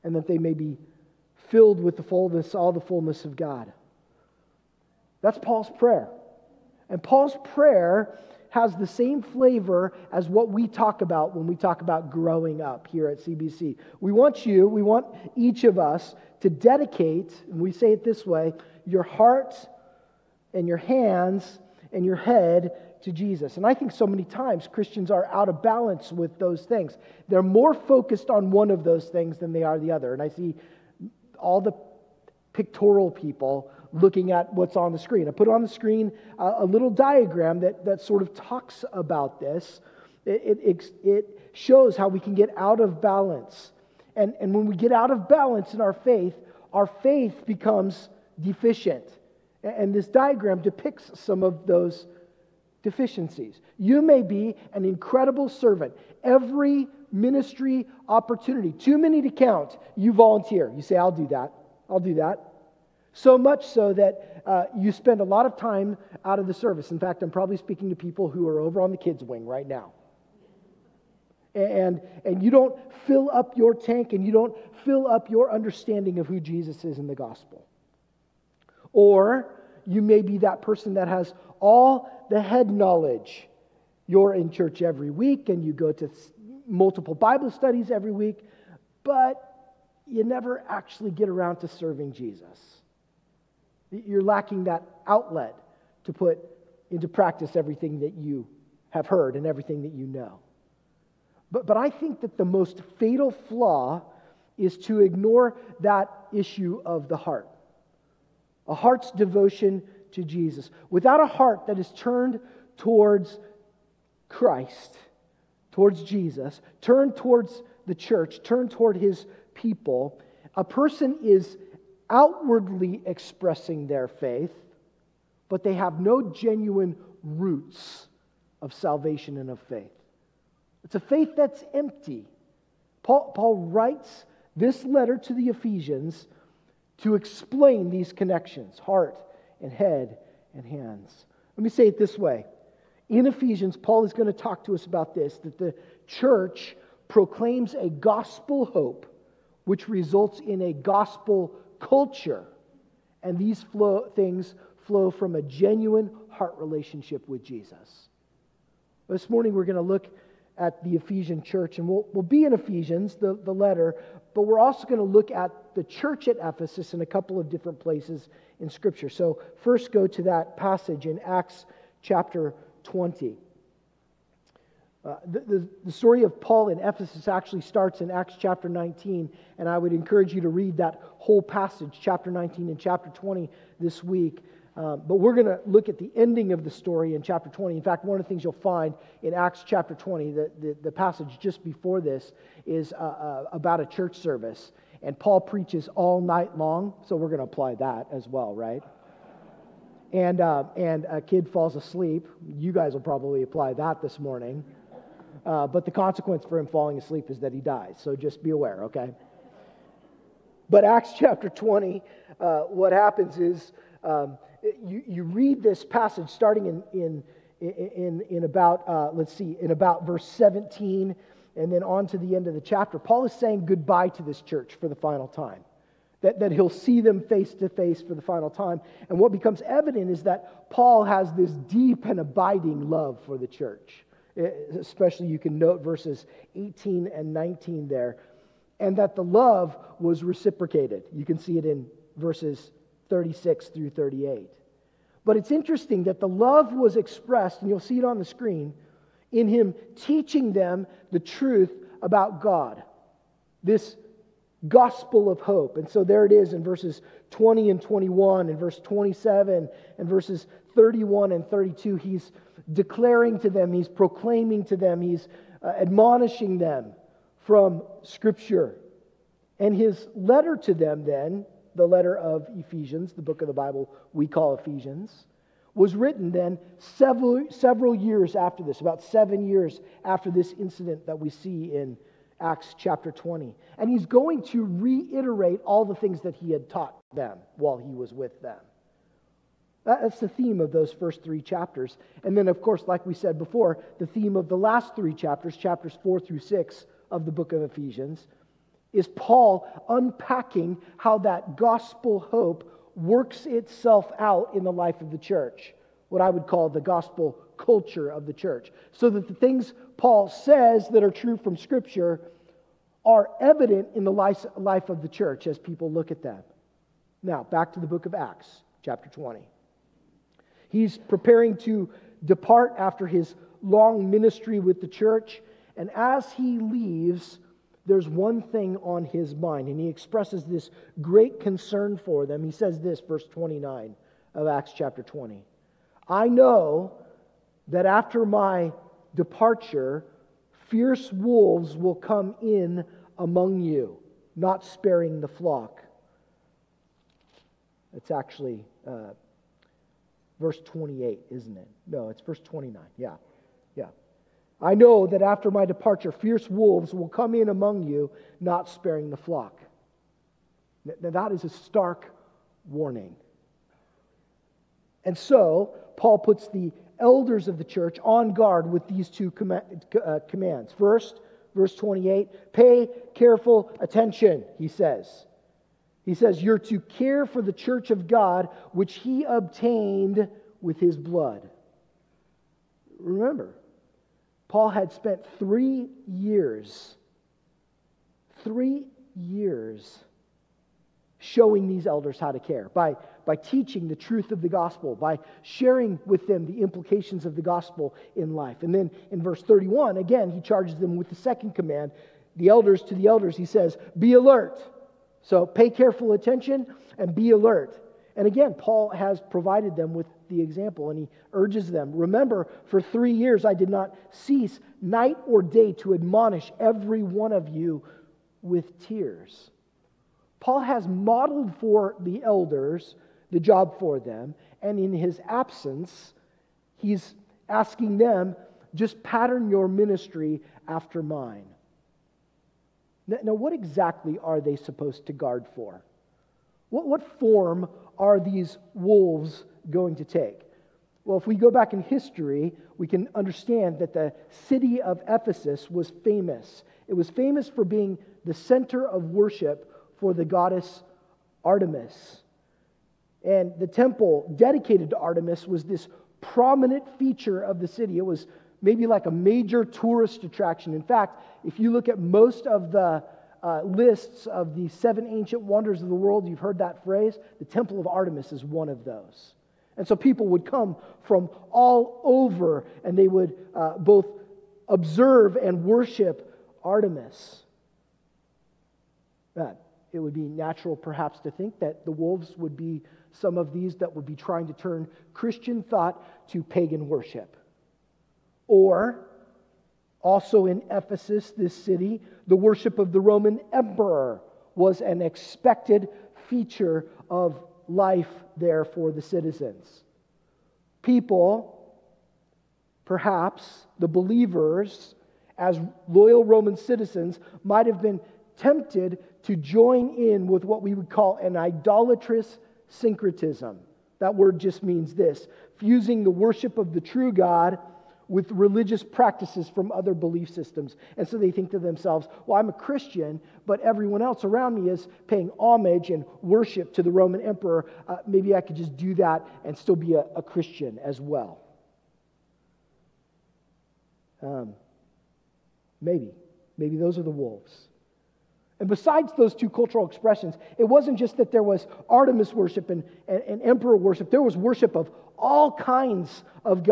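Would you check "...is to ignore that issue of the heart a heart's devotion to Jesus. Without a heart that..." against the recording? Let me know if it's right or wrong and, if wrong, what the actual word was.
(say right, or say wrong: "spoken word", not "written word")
right.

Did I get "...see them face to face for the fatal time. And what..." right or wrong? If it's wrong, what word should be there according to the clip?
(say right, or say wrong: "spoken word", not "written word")
wrong: "final", not "fatal".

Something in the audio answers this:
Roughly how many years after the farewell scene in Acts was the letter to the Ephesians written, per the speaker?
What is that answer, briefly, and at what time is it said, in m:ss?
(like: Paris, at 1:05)
7, at 4:39.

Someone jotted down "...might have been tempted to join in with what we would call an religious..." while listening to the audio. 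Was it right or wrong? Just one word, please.
wrong.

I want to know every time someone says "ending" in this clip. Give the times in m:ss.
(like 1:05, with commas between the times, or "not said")
3:06.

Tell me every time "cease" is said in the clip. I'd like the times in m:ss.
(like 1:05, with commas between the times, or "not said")
6:54.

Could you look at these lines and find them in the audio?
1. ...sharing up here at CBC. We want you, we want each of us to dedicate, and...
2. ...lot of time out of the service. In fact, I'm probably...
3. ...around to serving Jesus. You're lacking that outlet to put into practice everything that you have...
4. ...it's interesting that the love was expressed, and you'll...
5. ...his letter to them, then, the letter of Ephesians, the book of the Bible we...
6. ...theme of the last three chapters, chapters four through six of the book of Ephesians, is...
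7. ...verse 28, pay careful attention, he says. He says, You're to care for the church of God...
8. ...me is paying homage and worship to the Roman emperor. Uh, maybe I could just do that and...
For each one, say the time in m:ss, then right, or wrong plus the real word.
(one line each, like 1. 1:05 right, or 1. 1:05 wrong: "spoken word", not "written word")
1. 0:12 wrong: "growing", not "sharing"
2. 1:05 right
3. 1:31 right
4. 4:05 right
5. 4:29 right
6. 4:54 right
7. 6:11 right
8. 8:44 right.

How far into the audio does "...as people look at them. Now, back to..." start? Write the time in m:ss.
5:15.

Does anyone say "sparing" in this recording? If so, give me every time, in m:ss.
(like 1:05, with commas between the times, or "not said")
5:44, 5:58.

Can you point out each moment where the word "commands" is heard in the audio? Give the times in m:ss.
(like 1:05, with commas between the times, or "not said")
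6:10, 6:41.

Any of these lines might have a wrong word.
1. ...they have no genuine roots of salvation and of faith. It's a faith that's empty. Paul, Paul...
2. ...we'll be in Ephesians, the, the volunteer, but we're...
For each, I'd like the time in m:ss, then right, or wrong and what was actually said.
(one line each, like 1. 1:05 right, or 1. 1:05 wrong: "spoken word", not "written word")
1. 2:05 right
2. 2:42 wrong: "letter", not "volunteer".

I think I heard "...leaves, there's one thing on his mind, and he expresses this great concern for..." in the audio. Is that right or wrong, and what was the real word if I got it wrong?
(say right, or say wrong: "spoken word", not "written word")
right.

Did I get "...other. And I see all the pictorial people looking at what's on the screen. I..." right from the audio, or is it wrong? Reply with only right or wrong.
right.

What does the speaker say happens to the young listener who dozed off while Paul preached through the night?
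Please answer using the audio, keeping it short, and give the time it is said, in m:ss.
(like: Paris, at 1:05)
he dies, at 3:27.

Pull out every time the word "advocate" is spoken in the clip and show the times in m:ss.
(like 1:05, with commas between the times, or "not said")
not said.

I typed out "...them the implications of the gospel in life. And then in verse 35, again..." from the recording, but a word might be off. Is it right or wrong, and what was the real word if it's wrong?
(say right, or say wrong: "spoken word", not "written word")
wrong: "31", not "35".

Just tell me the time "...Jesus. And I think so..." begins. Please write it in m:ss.
0:23.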